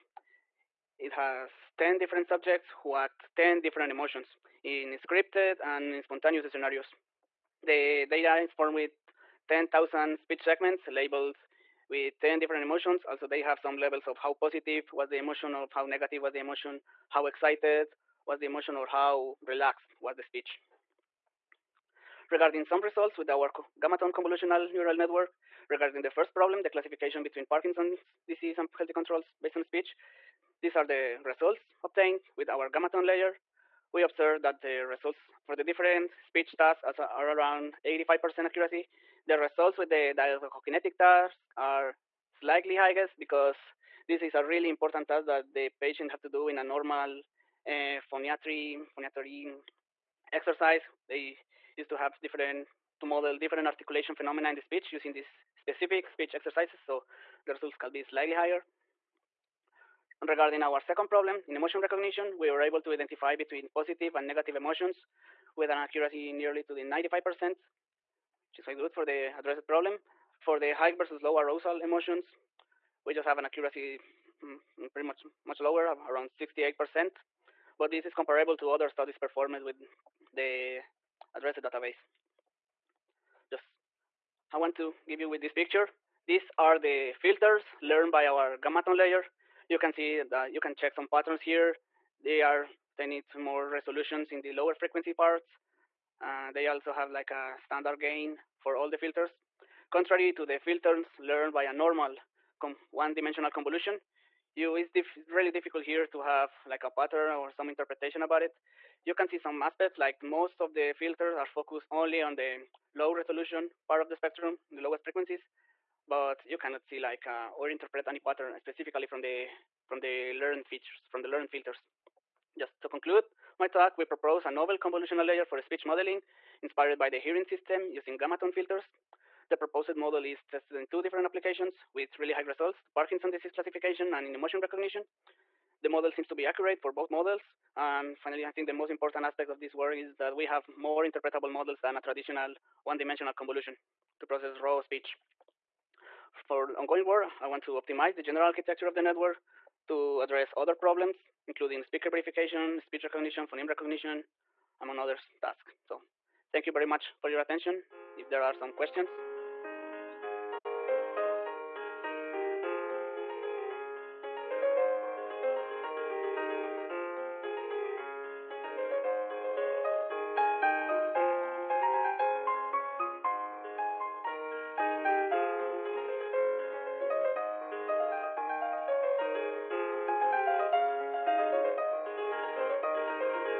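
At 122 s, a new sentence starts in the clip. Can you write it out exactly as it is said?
Just to conclude my talk, we propose a novel convolutional layer for speech modeling inspired by the hearing system using tone filters.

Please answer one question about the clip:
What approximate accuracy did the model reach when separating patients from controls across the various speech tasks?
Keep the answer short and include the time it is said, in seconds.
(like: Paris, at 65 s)
85%, at 37 s.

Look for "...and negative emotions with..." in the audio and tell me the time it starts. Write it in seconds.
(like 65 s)
64 s.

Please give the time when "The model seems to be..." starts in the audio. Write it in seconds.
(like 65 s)
135 s.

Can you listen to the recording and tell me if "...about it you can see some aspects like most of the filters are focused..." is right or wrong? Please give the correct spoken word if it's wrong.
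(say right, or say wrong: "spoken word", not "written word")
right.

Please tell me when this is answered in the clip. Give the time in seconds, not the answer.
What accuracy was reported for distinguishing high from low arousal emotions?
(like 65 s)
76 s.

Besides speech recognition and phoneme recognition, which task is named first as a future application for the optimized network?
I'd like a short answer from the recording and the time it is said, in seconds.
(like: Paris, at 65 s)
speaker verification, at 151 s.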